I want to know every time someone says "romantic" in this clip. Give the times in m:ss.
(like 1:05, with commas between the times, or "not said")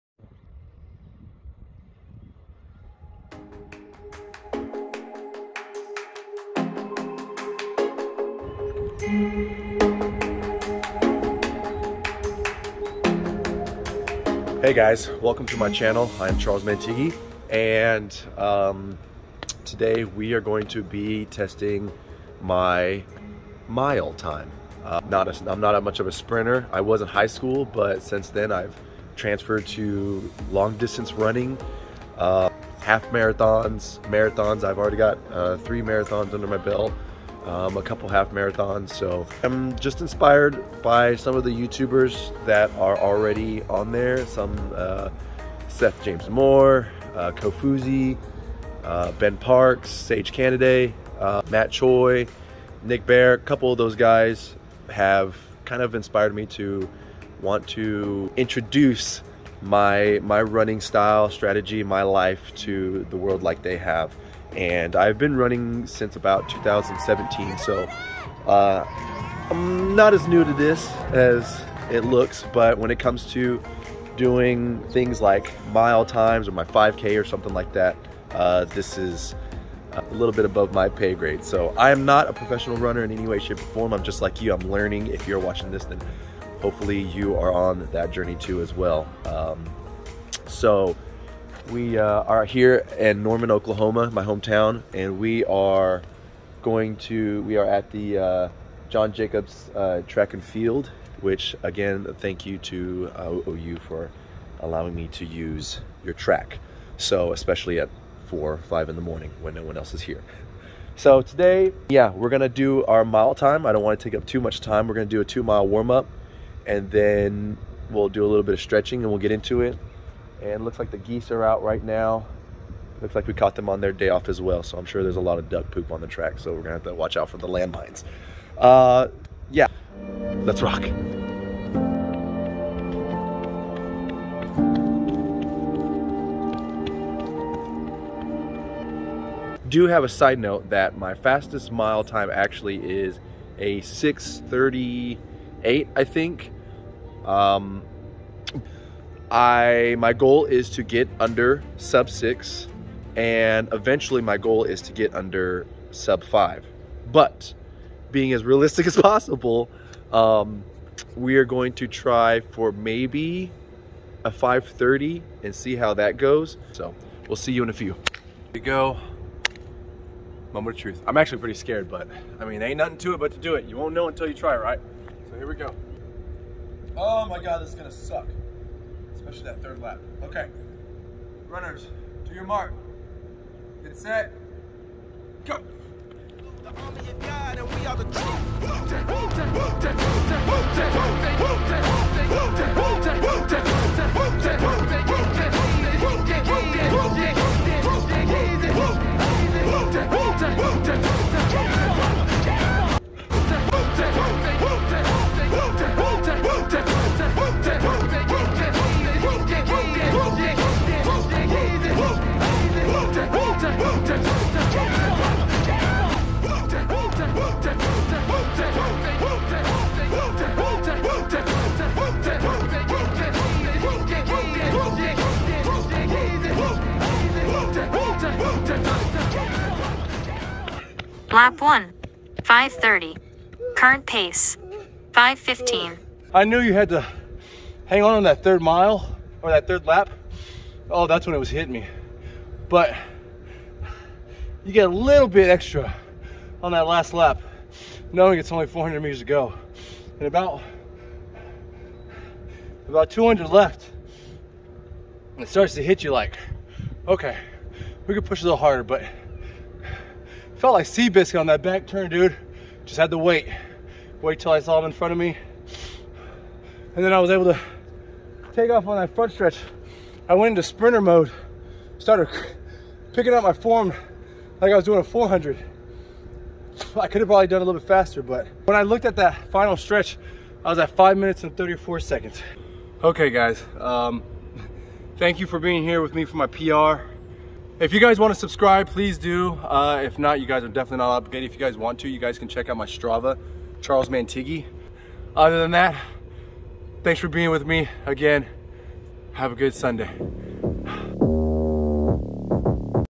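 not said.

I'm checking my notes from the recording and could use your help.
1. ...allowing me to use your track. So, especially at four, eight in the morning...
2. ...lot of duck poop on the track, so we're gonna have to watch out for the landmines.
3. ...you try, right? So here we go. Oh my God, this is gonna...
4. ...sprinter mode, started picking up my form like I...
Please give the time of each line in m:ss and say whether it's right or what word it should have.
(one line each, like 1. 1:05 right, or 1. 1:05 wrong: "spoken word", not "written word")
1. 1:44 wrong: "five", not "eight"
2. 2:05 right
3. 2:54 right
4. 4:30 right.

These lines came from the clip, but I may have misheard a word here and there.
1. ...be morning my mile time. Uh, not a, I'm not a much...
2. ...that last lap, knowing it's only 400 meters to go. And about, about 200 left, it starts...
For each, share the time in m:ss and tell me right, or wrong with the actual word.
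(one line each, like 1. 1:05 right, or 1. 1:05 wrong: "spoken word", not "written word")
1. 0:20 wrong: "testing", not "morning"
2. 4:06 right.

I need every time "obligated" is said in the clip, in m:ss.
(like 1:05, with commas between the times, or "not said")
4:51.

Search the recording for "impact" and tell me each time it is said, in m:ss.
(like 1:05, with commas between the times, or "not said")
not said.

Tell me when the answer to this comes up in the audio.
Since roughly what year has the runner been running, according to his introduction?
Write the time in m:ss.
1:06.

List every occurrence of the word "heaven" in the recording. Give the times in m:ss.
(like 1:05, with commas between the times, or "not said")
not said.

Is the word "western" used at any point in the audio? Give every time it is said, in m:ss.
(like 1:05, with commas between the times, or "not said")
not said.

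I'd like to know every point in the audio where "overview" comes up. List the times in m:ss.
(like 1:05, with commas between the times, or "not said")
not said.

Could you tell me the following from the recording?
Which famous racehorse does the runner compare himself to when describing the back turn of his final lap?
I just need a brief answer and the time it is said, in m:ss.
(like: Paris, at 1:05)
Seabiscuit, at 4:20.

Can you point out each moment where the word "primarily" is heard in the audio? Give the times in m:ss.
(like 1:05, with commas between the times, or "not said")
not said.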